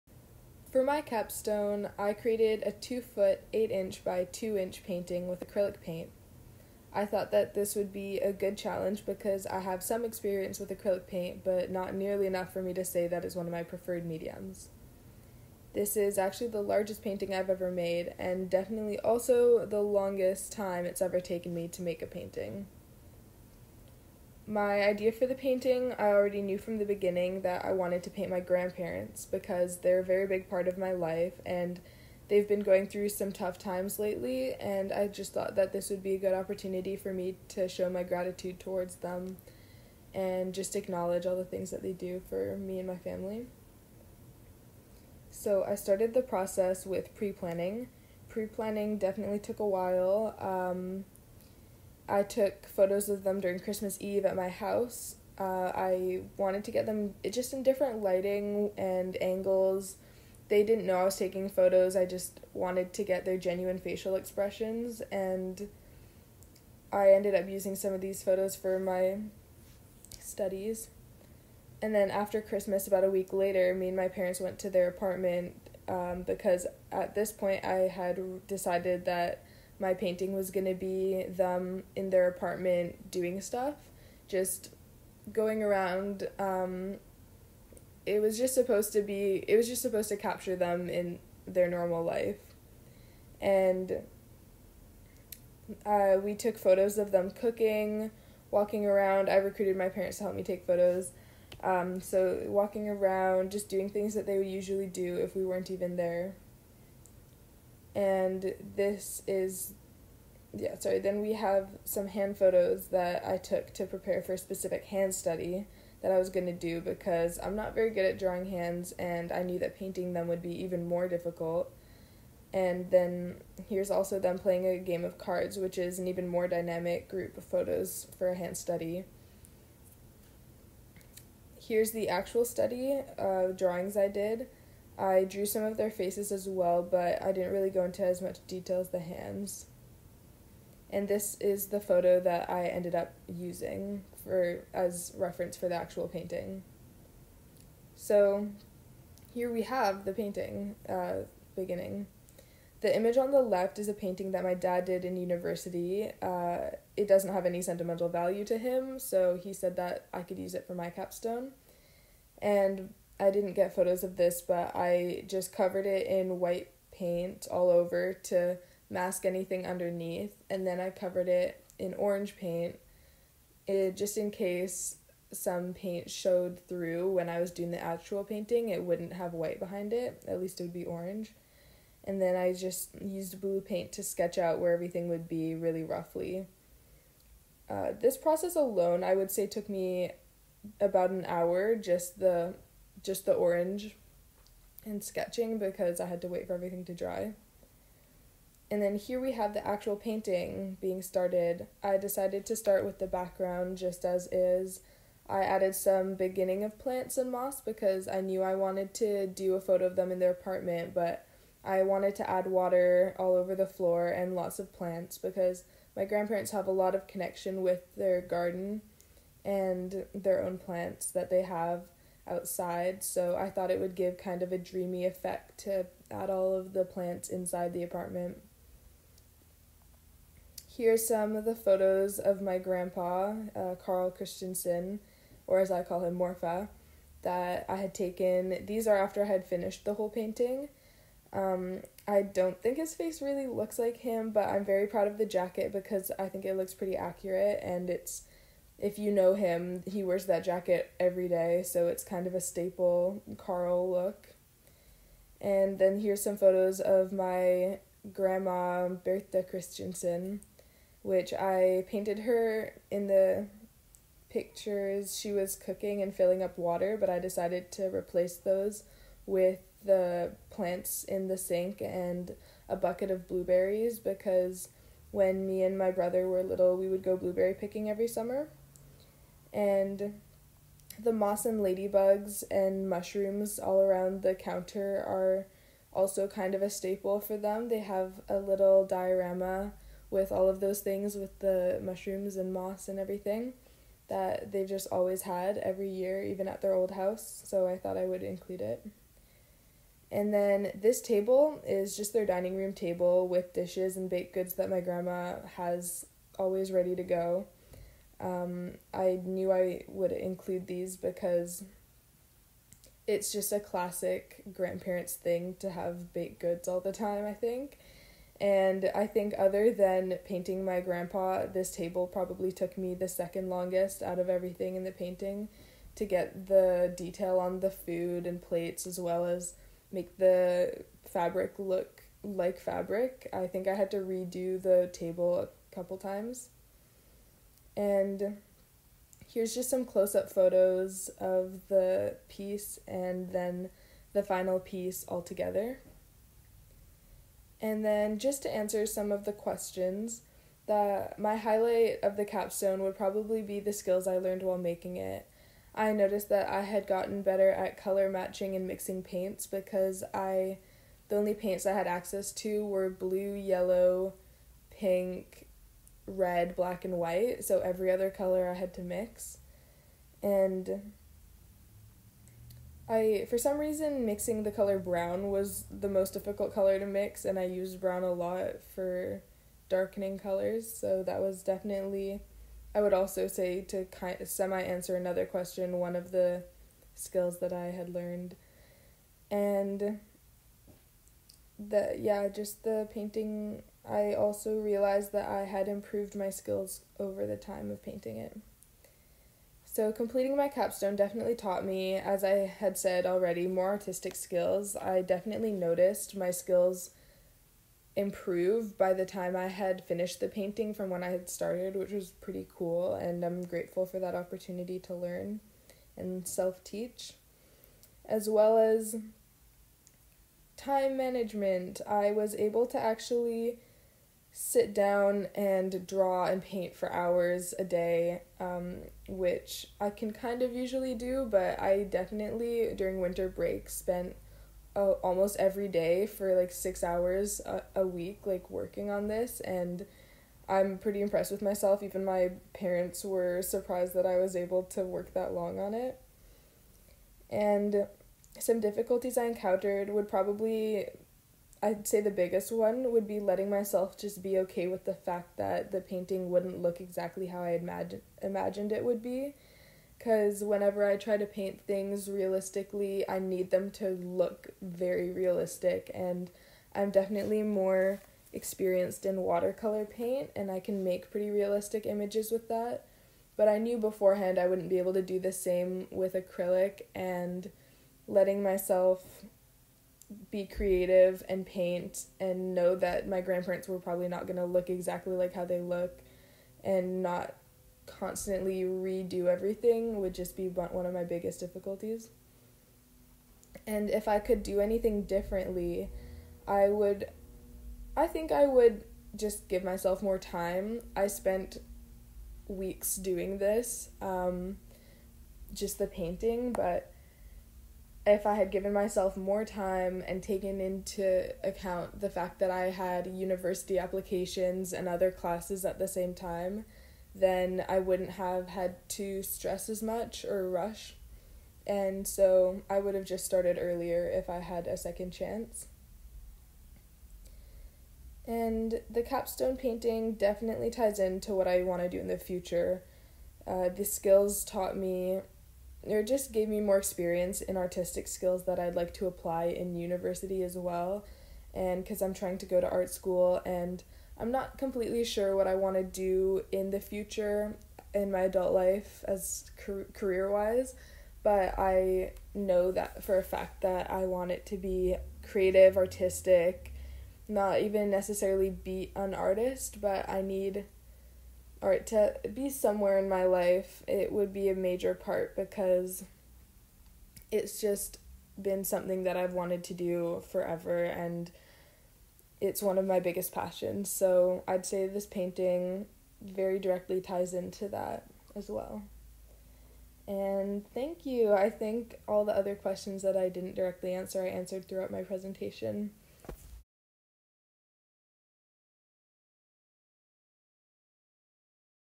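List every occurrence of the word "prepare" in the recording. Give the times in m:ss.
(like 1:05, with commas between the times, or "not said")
1:53.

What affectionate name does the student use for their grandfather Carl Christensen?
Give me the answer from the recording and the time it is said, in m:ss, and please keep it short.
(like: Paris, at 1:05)
Morfar, at 3:56.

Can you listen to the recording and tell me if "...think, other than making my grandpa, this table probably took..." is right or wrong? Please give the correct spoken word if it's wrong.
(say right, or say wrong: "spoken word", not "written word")
wrong: "painting", not "making".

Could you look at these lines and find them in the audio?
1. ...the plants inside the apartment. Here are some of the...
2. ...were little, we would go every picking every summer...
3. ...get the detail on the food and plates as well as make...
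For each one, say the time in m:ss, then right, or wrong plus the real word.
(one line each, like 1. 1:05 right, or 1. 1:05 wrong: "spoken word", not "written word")
1. 3:46 right
2. 4:36 wrong: "blueberry", not "every"
3. 5:26 right.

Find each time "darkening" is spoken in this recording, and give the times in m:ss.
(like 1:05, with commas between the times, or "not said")
6:19.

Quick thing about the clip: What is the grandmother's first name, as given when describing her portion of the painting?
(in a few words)
Bertha.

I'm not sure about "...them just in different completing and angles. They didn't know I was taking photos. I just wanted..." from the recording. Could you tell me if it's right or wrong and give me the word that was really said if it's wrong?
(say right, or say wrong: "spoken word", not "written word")
wrong: "lighting", not "completing".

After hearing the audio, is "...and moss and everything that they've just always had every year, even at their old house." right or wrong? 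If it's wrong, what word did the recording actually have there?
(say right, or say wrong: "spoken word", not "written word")
right.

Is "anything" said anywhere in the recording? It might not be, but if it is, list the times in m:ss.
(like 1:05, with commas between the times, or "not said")
2:49, 8:14.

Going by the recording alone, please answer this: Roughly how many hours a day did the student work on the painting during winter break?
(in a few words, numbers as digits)
6.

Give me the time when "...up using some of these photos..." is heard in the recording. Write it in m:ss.
1:07.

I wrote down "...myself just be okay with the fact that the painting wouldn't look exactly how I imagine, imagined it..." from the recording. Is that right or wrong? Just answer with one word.
right.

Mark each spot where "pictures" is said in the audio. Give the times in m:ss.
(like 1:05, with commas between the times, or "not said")
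4:24.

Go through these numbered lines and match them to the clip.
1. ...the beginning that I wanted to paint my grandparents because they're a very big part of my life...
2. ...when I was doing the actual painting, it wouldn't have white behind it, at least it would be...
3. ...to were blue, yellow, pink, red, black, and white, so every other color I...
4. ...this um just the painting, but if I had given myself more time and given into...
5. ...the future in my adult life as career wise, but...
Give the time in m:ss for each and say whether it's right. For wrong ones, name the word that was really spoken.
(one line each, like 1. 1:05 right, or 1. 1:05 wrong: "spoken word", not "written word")
1. 0:26 right
2. 2:57 right
3. 6:02 right
4. 8:23 wrong: "taken", not "given"
5. 9:06 right.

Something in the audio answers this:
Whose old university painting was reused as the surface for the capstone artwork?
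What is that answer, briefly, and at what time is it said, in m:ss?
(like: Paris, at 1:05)
Dad's, at 2:34.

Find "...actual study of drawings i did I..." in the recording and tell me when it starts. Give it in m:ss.
2:12.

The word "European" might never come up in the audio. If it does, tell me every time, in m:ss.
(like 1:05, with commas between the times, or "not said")
not said.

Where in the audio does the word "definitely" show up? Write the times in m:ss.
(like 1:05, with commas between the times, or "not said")
0:18, 0:48, 6:21, 6:40, 6:45, 7:11, 7:46, 8:50.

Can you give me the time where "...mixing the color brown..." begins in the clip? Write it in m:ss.
6:14.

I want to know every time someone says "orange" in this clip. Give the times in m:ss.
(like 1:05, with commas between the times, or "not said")
2:51, 3:00, 3:13.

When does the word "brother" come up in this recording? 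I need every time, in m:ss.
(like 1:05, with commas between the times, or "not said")
4:35.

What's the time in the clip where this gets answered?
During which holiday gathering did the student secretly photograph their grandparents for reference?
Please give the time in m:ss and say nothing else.
0:53.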